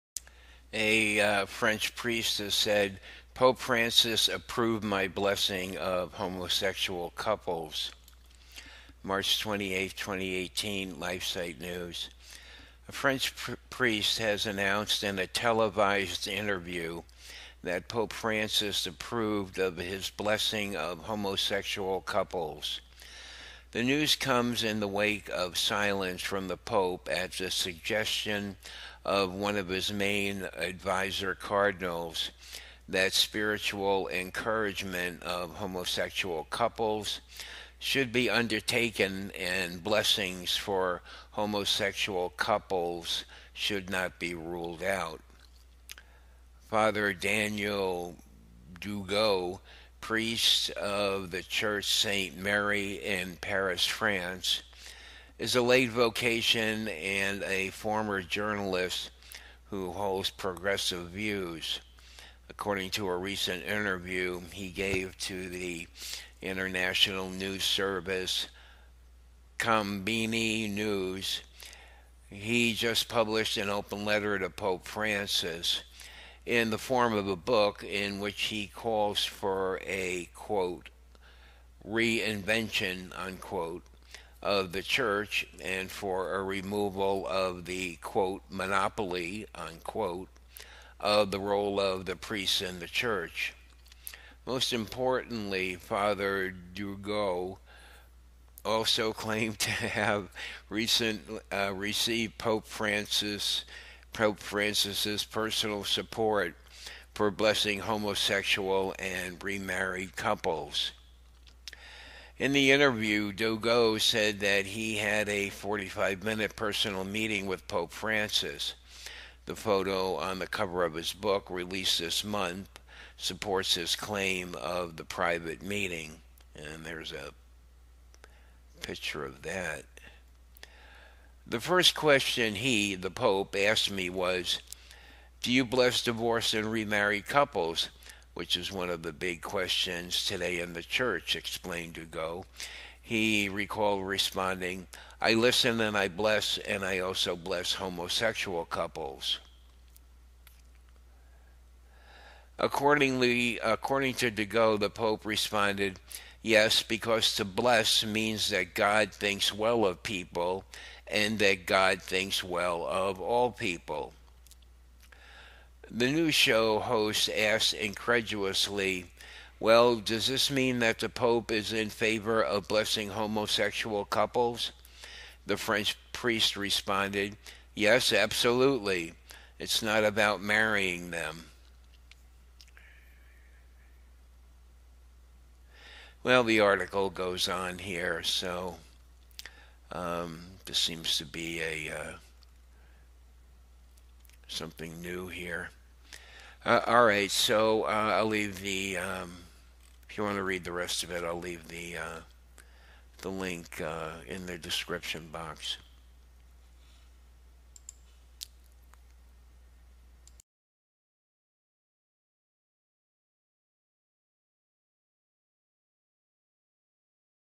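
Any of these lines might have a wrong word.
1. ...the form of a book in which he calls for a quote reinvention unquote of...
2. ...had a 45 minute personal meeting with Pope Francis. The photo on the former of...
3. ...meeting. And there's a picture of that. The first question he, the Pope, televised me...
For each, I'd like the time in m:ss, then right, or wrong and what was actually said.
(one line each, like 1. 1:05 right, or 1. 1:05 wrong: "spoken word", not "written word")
1. 1:16 right
2. 1:54 wrong: "cover", not "former"
3. 2:05 wrong: "asked", not "televised".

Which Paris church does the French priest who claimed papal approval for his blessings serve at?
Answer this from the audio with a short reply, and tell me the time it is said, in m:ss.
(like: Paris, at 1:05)
St. Merry, at 0:51.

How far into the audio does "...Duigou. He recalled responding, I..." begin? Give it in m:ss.
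2:21.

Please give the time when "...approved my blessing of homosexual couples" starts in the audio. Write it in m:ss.
0:04.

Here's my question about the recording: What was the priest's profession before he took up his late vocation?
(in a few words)
journalist.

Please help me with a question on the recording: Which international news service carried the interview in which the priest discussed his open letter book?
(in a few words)
Konbini News.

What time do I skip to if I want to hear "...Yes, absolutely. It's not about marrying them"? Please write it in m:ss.
2:57.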